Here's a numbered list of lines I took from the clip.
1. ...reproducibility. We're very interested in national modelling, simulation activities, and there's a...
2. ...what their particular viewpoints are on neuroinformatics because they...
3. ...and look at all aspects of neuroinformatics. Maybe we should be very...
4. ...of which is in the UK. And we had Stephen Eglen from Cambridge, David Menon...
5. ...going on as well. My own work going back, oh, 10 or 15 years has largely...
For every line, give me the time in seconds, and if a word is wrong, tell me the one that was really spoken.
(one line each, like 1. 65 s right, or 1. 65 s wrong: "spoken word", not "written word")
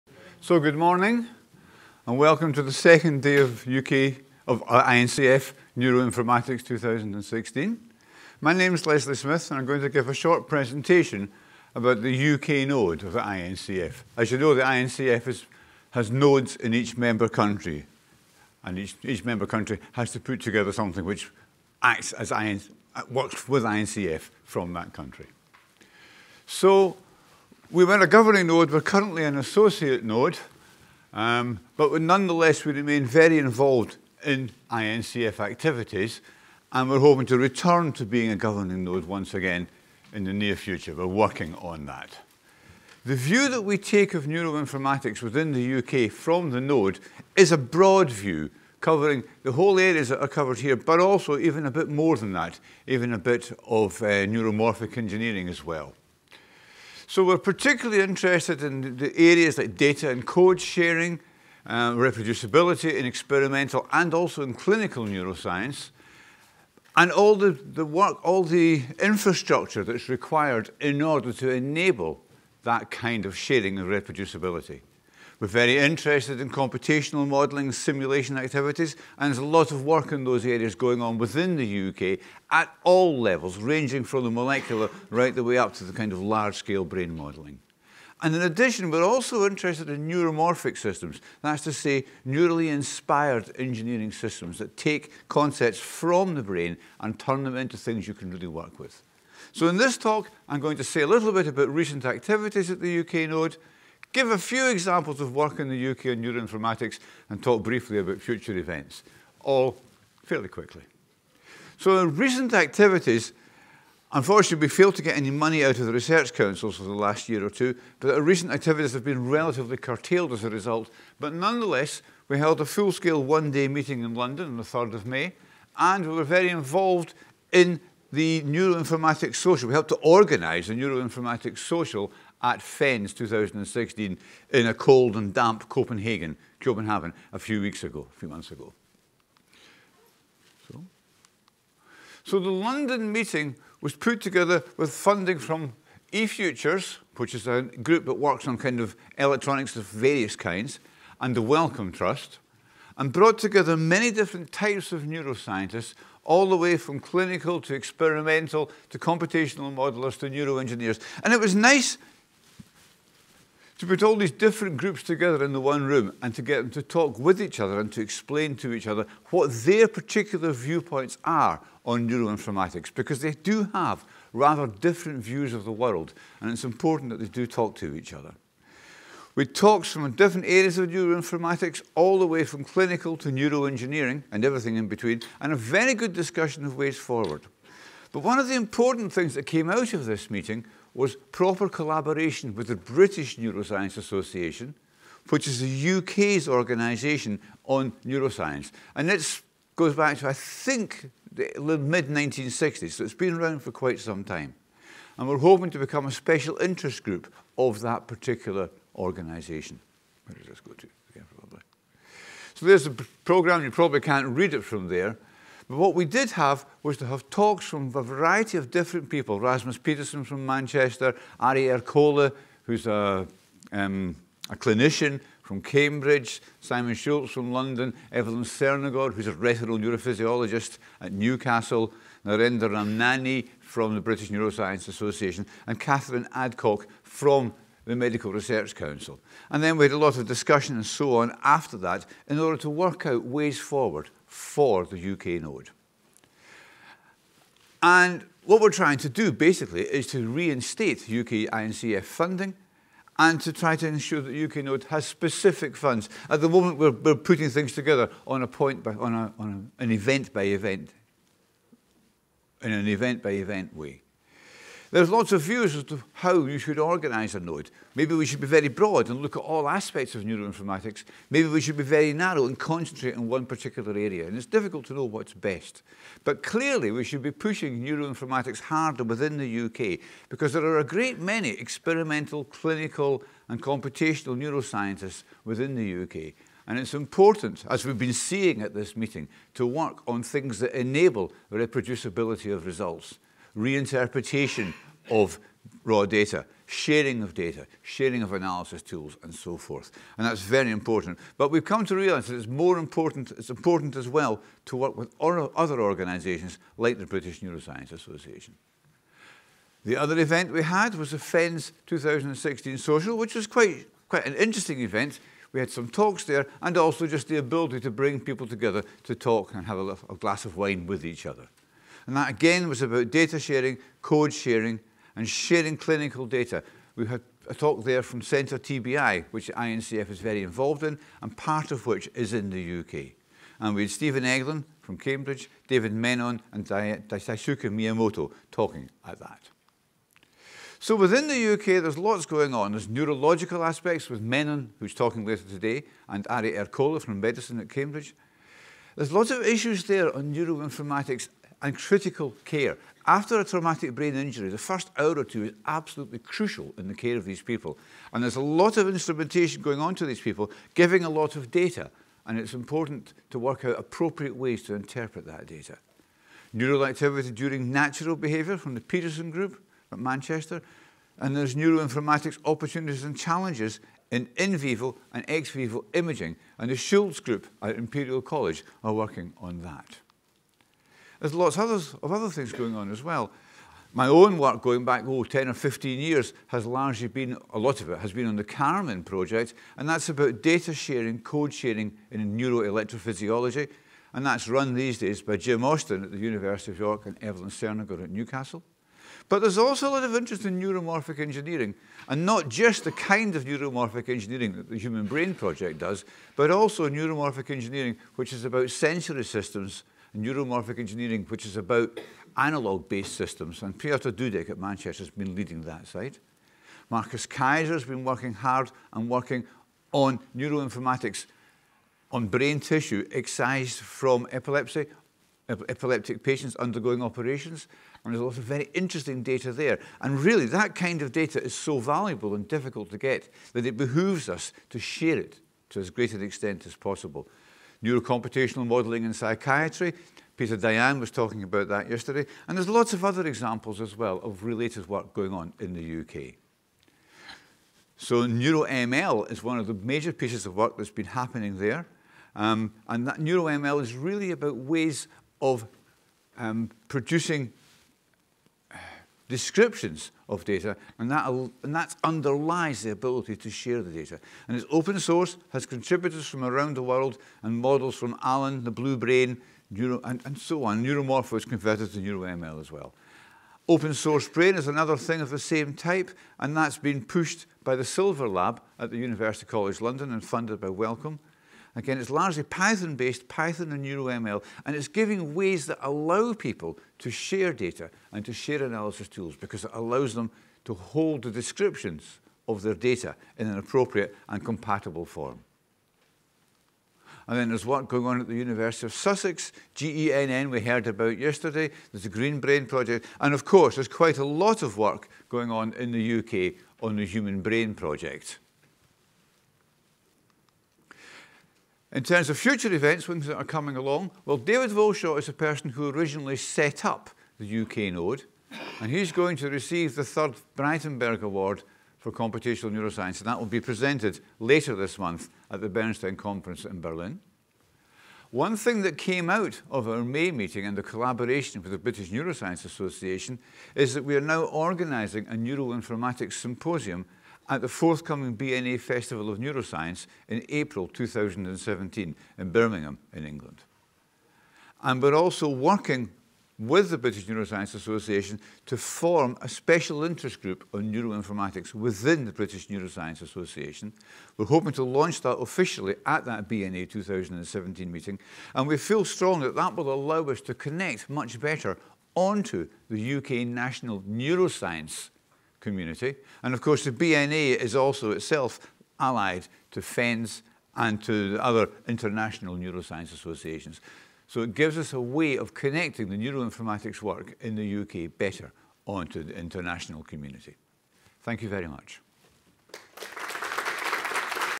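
1. 73 s wrong: "computational", not "national"
2. 169 s right
3. 269 s right
4. 331 s right
5. 382 s right.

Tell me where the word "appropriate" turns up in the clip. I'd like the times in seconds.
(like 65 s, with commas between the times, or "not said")
363 s, 493 s.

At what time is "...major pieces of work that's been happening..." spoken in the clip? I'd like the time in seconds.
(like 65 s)
449 s.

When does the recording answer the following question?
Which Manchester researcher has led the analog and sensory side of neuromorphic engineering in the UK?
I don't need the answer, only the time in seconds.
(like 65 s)
413 s.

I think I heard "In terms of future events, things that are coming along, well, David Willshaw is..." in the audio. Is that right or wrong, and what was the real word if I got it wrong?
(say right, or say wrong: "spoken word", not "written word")
right.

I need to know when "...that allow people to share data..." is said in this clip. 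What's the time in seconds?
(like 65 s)
485 s.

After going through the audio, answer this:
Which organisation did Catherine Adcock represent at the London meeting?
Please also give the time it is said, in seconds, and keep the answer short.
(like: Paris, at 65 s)
Medical Research Council, at 237 s.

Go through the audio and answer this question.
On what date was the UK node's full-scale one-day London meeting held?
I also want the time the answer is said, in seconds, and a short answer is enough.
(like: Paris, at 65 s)
3rd of May, at 124 s.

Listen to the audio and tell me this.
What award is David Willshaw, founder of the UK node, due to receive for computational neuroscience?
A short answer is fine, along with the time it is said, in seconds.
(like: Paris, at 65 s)
Braitenberg Award, at 520 s.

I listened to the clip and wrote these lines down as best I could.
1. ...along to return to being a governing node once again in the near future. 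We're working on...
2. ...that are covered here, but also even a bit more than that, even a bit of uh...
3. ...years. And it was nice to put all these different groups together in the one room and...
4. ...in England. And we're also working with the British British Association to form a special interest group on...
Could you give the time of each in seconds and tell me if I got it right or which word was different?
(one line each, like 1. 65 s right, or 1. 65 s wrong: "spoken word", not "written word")
1. 36 s wrong: "hoping", not "along"
2. 50 s right
3. 160 s wrong: "neuroengineers", not "years"
4. 543 s wrong: "Neuroscience", not "British".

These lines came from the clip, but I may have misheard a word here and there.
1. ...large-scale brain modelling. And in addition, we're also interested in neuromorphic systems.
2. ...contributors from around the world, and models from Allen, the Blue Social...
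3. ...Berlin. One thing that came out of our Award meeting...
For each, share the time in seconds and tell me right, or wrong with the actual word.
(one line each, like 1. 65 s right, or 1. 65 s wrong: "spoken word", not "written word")
1. 86 s right
2. 465 s wrong: "Brain", not "Social"
3. 526 s wrong: "May", not "Award".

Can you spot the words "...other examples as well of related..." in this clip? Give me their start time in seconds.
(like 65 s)
443 s.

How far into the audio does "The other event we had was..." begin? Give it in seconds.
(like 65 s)
309 s.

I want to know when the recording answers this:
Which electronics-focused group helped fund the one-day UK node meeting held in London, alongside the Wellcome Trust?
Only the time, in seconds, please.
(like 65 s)
146 s.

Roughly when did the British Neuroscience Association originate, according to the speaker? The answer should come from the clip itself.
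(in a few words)
mid-1960s.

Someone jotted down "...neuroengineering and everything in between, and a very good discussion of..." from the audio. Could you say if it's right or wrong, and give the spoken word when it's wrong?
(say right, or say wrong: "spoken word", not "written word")
right.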